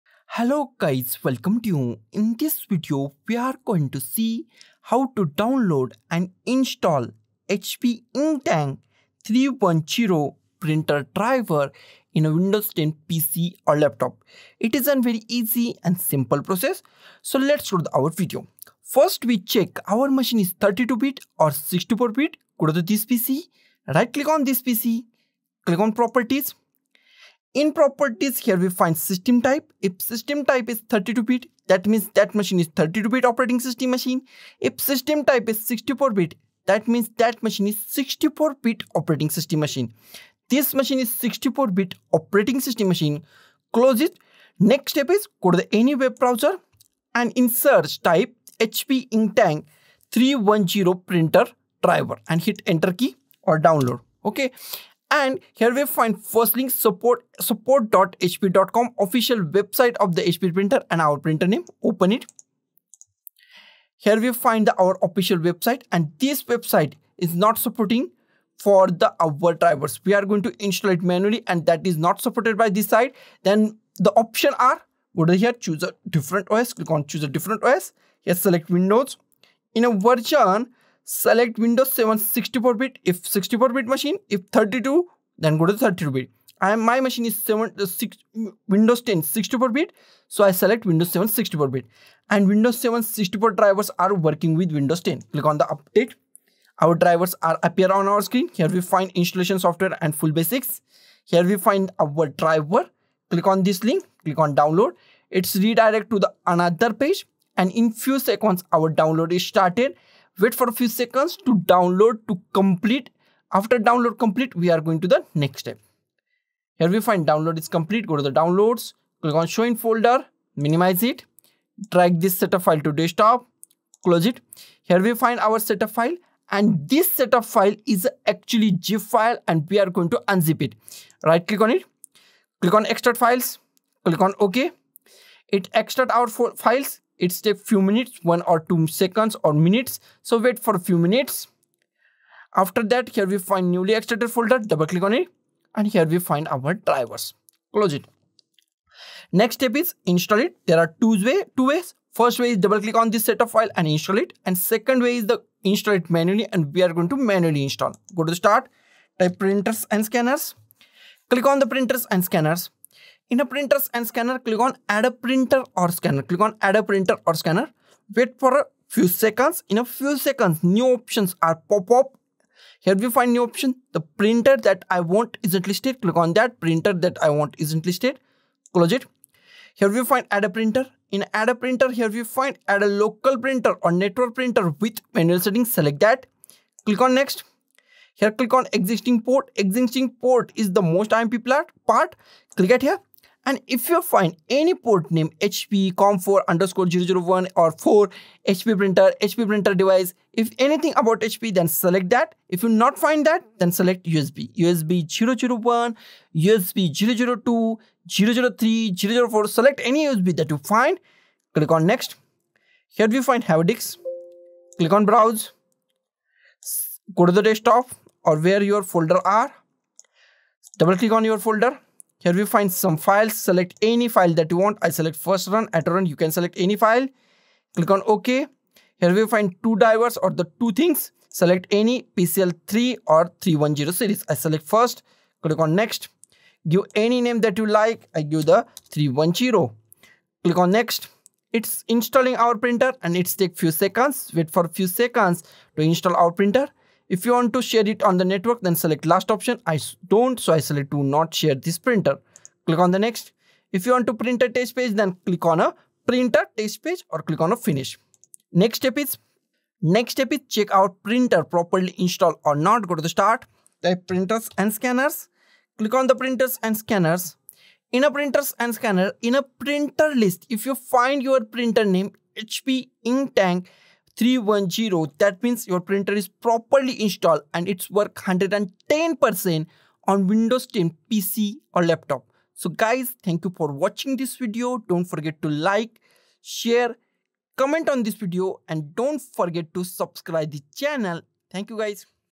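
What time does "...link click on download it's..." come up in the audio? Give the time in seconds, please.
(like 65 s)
103 s.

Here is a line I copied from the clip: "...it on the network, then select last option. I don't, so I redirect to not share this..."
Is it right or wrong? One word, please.
wrong.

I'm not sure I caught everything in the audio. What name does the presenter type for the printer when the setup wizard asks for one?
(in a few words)
310.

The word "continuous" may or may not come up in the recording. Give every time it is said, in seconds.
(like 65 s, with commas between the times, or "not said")
not said.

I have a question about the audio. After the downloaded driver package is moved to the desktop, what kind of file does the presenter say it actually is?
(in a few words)
Zip file.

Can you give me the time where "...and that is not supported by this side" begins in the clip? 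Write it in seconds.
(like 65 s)
71 s.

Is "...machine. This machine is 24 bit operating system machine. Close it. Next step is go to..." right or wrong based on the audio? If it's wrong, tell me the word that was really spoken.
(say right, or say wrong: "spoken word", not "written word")
wrong: "64", not "24".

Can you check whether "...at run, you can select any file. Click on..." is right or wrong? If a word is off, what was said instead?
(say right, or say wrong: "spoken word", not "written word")
right.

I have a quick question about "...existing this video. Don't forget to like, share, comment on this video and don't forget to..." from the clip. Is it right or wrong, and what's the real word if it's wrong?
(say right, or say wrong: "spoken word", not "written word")
wrong: "watching", not "existing".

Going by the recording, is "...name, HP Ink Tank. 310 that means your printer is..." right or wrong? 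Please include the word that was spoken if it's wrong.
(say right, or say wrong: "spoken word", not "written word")
right.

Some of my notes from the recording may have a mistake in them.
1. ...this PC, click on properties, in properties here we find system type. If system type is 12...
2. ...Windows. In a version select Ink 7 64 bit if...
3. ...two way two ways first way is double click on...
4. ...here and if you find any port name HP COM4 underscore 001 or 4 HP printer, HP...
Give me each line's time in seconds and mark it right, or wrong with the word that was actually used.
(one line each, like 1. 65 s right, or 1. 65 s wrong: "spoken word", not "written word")
1. 24 s wrong: "32", not "12"
2. 78 s wrong: "Windows", not "Ink"
3. 151 s right
4. 192 s right.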